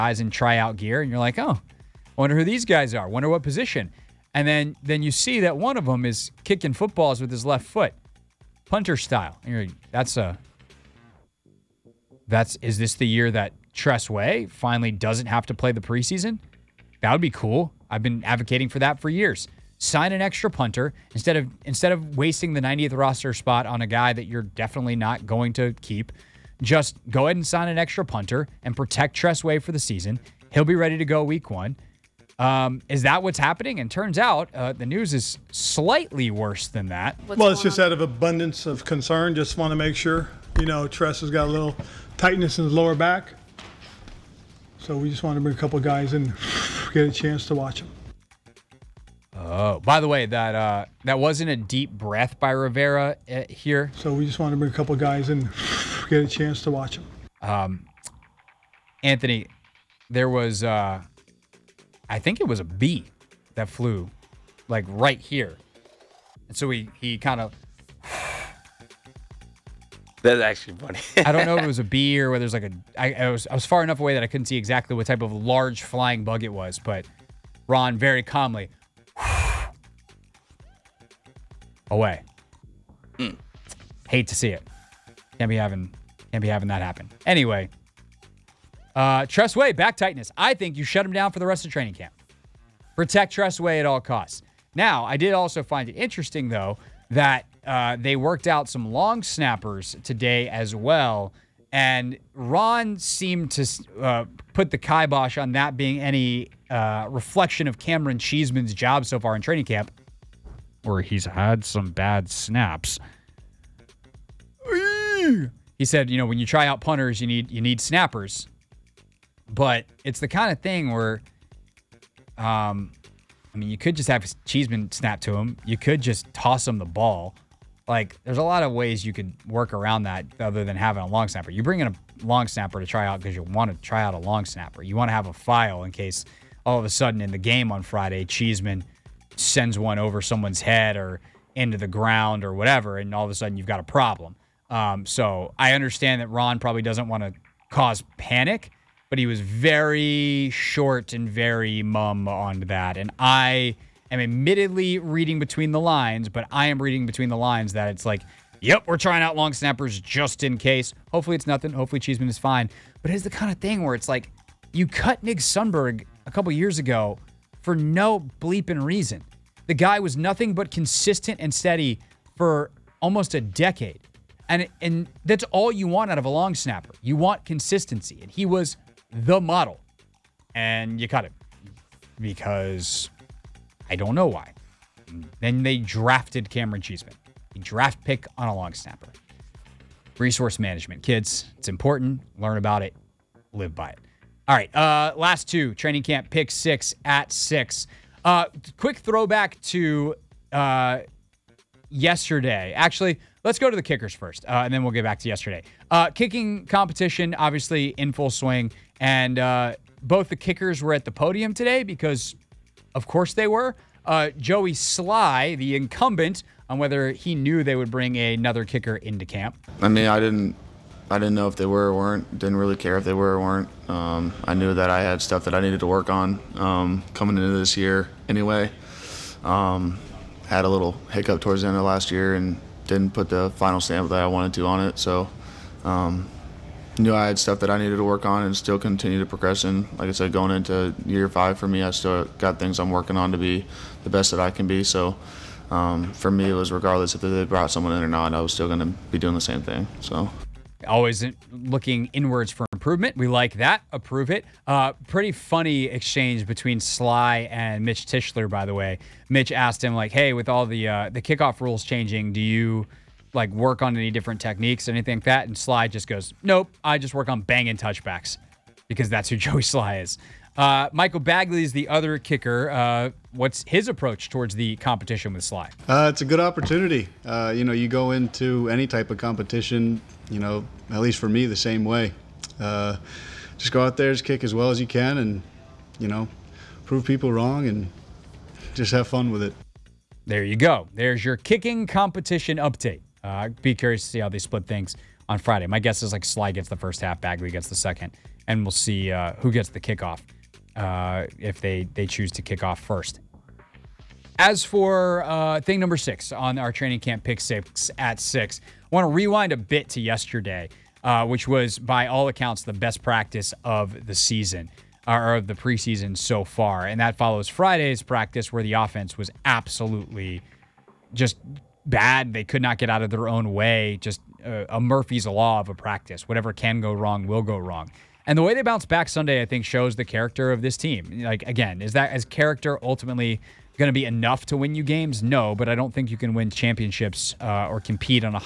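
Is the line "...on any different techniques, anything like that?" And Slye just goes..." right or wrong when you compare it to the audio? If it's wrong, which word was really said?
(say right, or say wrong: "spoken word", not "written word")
right.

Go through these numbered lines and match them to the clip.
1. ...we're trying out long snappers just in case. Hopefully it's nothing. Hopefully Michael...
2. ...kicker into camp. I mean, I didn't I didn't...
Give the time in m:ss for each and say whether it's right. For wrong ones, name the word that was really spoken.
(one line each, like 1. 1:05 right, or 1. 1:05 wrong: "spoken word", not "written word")
1. 2:38 wrong: "Cheeseman", not "Michael"
2. 3:38 right.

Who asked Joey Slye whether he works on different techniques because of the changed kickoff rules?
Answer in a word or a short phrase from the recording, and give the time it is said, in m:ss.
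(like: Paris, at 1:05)
Mitch Tischler, at 4:17.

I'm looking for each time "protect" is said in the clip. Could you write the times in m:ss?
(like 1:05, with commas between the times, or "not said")
0:28, 1:32.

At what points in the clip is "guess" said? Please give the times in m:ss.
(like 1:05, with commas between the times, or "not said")
4:55.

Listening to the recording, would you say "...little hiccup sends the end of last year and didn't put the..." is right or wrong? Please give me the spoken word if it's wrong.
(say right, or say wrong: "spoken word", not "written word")
wrong: "towards", not "sends".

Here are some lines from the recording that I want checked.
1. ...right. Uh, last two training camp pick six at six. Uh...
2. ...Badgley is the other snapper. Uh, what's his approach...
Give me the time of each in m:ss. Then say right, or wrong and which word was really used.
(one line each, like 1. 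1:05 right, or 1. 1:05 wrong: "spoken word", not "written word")
1. 3:14 right
2. 4:31 wrong: "kicker", not "snapper".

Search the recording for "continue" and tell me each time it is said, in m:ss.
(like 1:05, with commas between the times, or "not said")
3:58.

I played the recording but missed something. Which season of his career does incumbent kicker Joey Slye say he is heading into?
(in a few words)
5.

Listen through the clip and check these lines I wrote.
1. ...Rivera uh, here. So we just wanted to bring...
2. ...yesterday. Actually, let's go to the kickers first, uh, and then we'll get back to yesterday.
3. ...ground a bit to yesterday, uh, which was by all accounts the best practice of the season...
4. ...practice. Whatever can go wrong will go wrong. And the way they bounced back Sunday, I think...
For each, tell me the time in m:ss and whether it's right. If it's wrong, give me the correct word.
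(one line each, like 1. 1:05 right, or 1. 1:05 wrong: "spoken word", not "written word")
1. 0:52 right
2. 3:21 right
3. 5:09 wrong: "rewind", not "ground"
4. 5:25 right.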